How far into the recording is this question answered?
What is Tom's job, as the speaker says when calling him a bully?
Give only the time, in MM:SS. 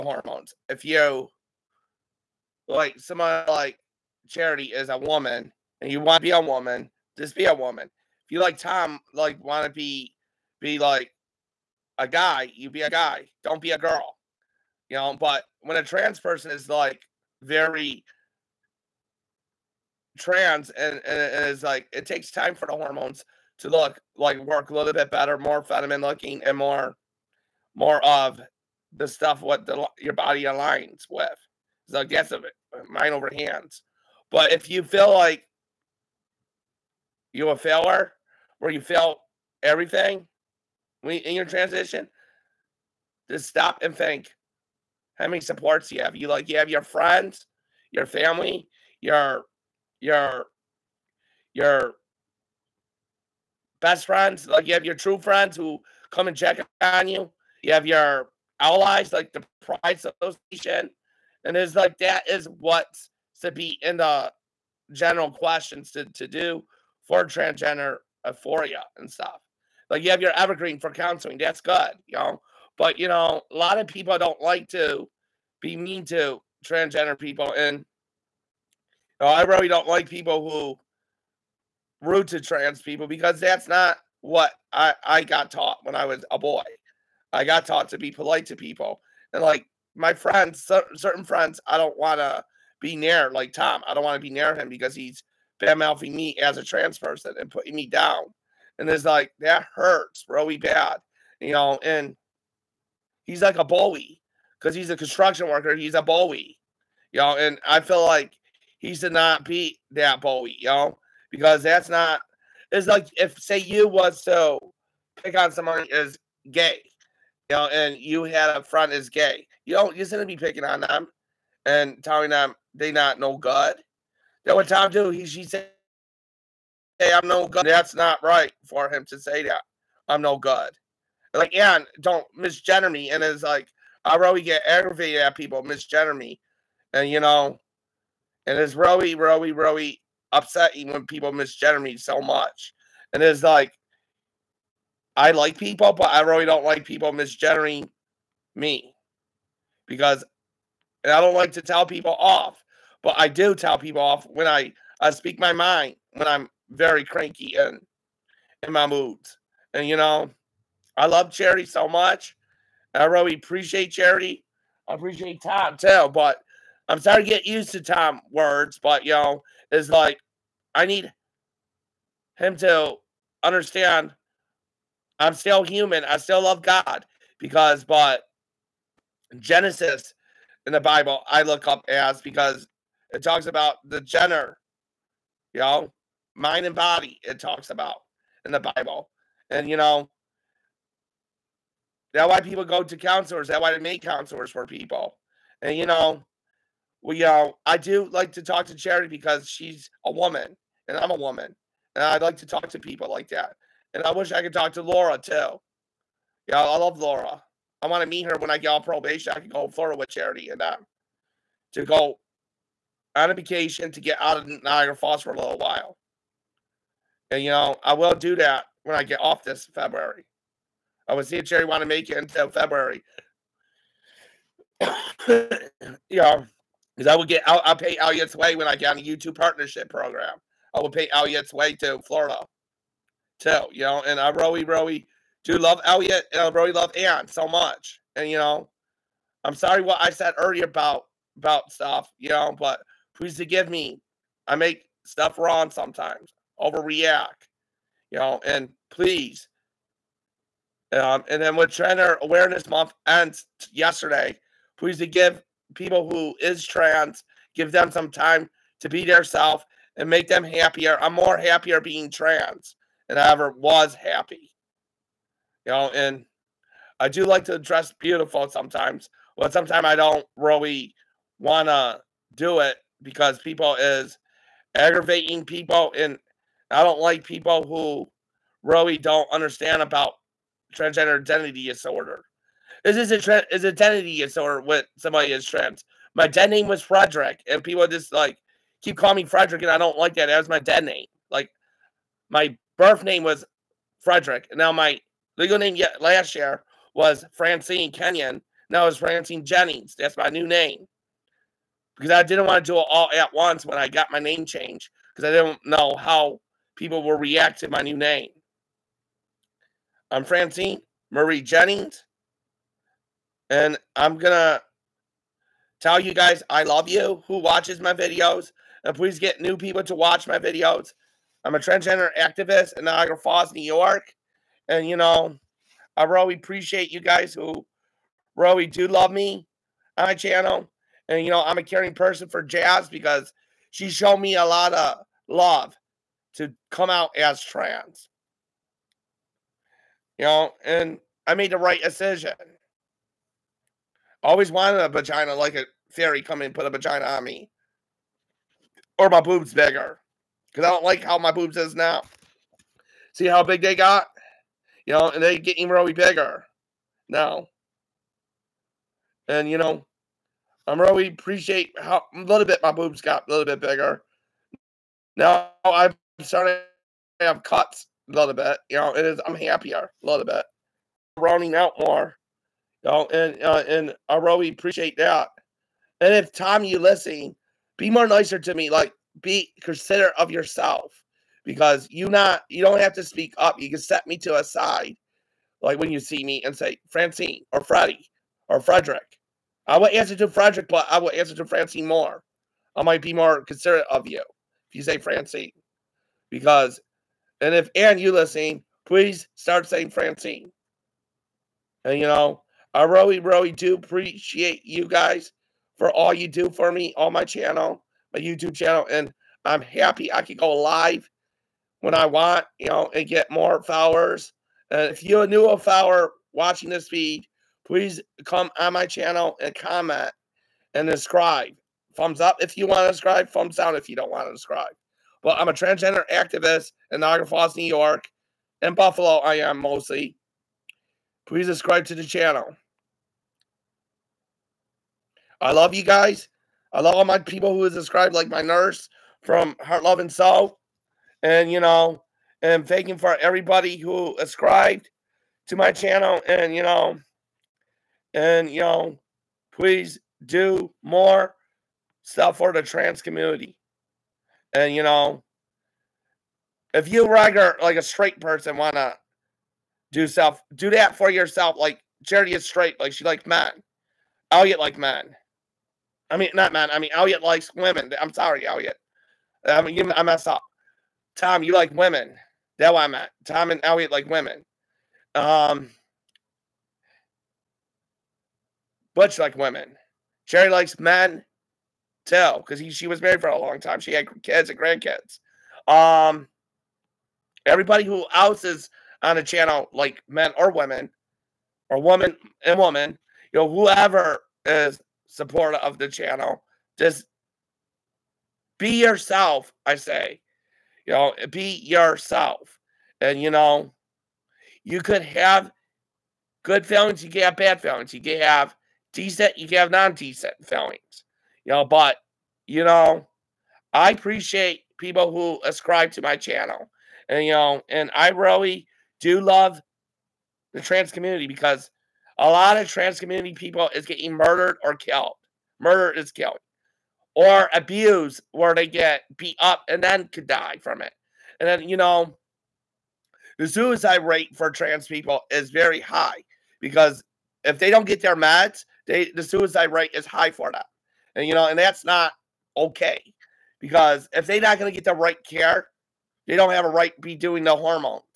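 01:44.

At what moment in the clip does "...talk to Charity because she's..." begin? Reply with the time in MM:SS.
03:18.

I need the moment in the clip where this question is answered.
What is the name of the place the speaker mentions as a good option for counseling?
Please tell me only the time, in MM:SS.
01:10.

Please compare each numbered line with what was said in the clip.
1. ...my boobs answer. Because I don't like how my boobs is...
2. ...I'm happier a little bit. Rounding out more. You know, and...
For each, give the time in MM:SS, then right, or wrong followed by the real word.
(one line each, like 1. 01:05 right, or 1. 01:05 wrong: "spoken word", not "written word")
1. 05:49 wrong: "bigger", not "answer"
2. 06:09 right.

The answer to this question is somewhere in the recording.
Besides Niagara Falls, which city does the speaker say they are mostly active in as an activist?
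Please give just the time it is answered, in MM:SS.
07:08.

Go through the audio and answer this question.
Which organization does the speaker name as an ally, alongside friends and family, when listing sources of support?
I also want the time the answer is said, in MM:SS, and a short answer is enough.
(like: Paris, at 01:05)
Pride Association, at 00:59.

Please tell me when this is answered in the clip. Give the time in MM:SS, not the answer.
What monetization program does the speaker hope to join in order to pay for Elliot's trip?
03:49.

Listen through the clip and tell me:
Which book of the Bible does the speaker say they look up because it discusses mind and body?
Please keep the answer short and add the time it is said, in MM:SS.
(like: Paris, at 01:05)
Genesis, at 02:59.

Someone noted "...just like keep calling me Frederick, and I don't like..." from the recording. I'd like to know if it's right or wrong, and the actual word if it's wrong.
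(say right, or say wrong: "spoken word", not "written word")
right.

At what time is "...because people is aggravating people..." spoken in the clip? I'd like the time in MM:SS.
04:33.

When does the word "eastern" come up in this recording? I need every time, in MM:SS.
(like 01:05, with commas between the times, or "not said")
not said.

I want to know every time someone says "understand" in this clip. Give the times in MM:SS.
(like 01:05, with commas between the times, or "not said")
02:53, 04:39.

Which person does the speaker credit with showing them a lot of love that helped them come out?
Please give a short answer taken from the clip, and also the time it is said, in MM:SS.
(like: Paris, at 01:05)
Jazz, at 05:32.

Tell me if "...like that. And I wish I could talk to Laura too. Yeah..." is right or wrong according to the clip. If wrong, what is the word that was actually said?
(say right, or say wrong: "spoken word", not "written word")
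right.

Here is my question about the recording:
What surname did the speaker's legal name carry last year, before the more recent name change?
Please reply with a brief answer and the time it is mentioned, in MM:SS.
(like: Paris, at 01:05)
Kenyon, at 04:57.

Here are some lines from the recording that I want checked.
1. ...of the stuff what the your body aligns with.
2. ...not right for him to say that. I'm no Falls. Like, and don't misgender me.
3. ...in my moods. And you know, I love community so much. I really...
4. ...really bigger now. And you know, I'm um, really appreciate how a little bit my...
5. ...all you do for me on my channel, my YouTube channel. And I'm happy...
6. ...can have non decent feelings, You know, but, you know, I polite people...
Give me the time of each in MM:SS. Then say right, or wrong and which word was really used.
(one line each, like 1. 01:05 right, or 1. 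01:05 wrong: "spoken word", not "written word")
1. 00:28 right
2. 02:07 wrong: "God", not "Falls"
3. 02:38 wrong: "charity", not "community"
4. 05:55 right
5. 06:45 right
6. 08:29 wrong: "appreciate", not "polite".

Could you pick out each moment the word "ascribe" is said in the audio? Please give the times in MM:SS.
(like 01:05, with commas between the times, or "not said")
08:35.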